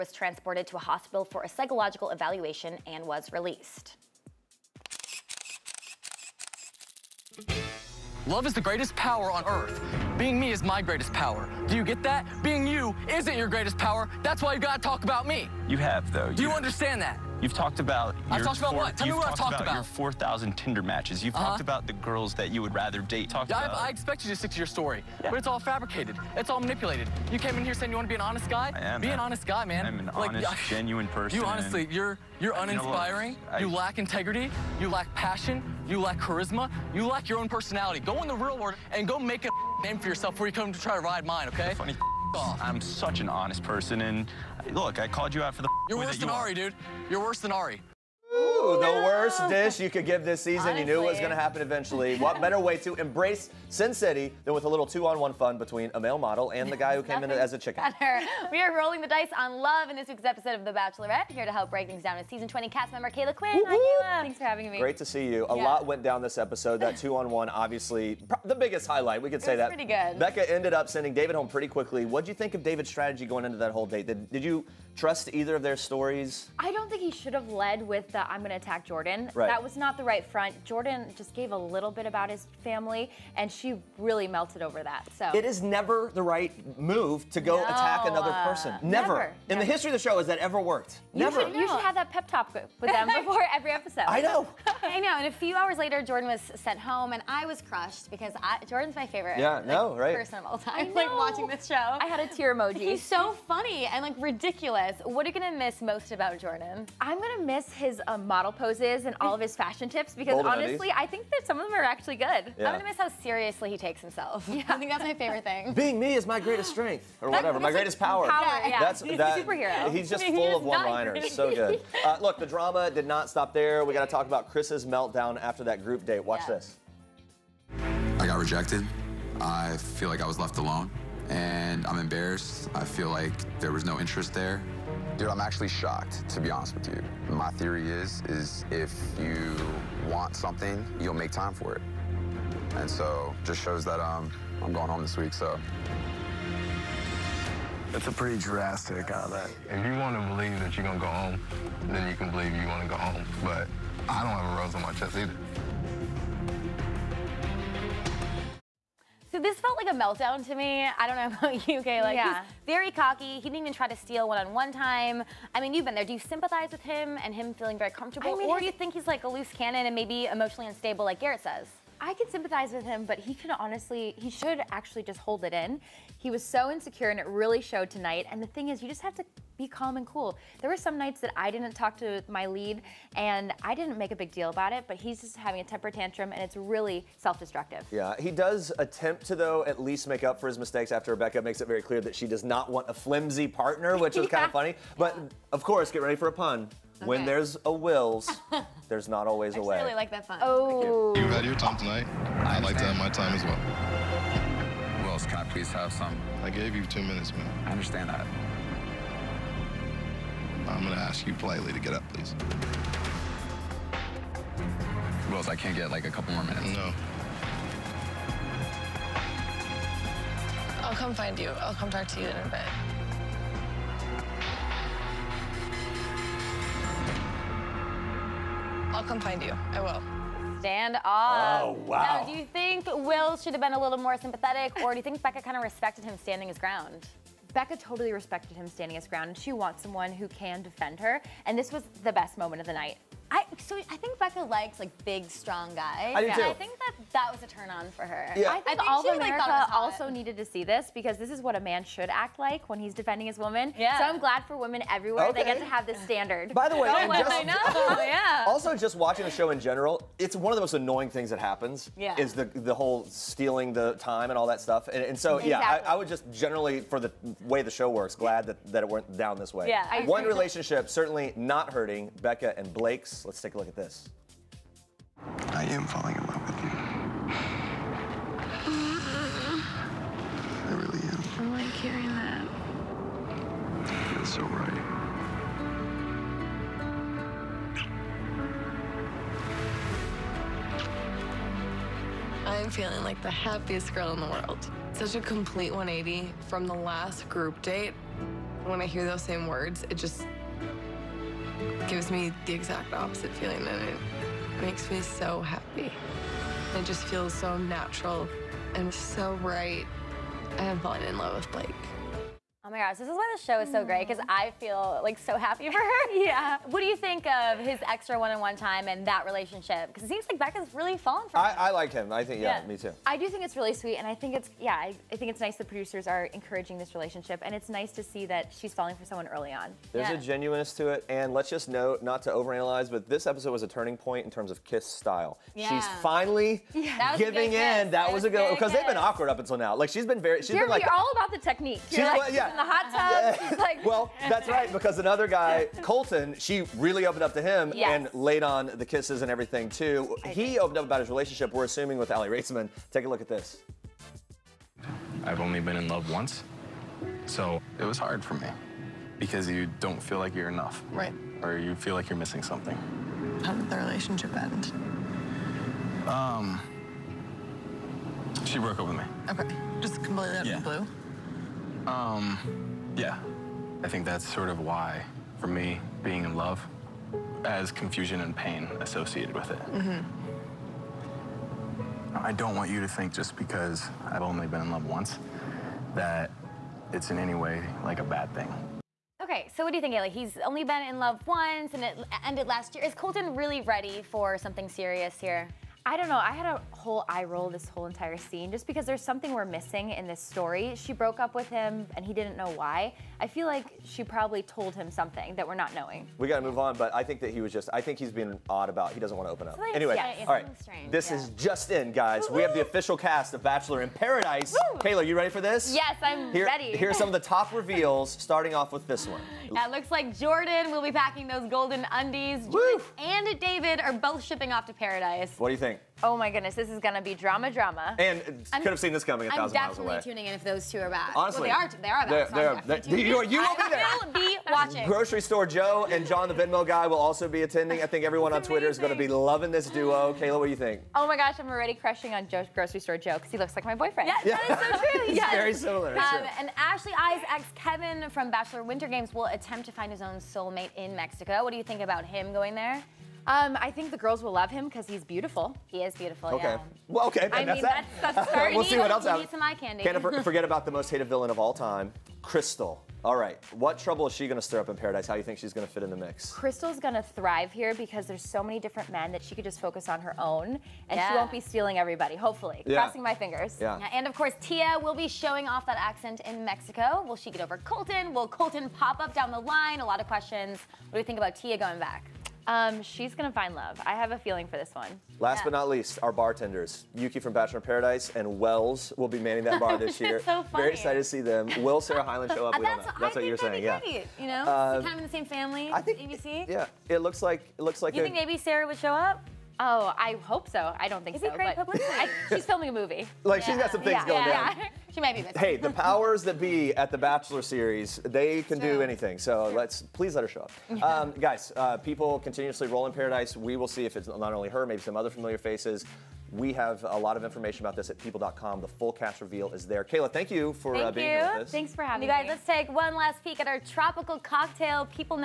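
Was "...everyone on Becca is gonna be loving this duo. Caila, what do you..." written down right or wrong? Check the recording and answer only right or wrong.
wrong.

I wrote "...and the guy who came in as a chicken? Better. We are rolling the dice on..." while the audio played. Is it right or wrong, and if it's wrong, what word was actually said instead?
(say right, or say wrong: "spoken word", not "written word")
right.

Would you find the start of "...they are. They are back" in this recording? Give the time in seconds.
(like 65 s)
431 s.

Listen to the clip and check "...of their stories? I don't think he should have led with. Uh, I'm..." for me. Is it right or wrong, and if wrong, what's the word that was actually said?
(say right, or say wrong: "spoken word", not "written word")
right.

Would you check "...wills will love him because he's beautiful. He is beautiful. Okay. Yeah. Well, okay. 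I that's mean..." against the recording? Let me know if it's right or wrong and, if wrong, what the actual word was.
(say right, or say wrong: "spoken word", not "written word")
wrong: "girls", not "wills".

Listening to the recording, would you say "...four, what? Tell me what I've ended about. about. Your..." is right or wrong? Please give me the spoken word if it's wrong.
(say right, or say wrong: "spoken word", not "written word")
wrong: "talked", not "ended".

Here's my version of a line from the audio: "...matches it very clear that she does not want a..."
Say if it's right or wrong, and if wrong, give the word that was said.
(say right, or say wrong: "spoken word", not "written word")
wrong: "makes", not "matches".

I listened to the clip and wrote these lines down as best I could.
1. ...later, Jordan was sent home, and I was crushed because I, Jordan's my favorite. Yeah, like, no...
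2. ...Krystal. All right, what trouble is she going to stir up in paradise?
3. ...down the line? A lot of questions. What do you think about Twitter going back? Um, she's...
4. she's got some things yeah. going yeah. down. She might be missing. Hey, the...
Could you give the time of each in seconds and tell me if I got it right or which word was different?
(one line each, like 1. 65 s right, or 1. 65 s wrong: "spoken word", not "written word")
1. 95 s right
2. 462 s right
3. 479 s wrong: "Tia", not "Twitter"
4. 503 s right.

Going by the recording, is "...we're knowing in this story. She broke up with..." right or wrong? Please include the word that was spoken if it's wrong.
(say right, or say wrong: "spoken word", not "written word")
wrong: "missing", not "knowing".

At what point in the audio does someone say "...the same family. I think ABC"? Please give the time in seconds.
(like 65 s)
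495 s.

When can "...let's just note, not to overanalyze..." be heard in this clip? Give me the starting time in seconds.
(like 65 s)
331 s.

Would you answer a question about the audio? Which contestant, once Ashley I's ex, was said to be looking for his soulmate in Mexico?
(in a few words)
Kevin.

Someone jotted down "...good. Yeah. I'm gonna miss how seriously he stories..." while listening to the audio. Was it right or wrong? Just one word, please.
wrong.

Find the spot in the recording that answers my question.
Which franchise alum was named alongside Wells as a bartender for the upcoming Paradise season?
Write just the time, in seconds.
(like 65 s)
486 s.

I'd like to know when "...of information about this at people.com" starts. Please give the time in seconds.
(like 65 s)
517 s.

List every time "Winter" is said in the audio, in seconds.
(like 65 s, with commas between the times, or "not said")
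448 s.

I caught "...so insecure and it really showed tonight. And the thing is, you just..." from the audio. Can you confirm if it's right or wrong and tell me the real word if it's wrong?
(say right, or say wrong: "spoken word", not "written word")
right.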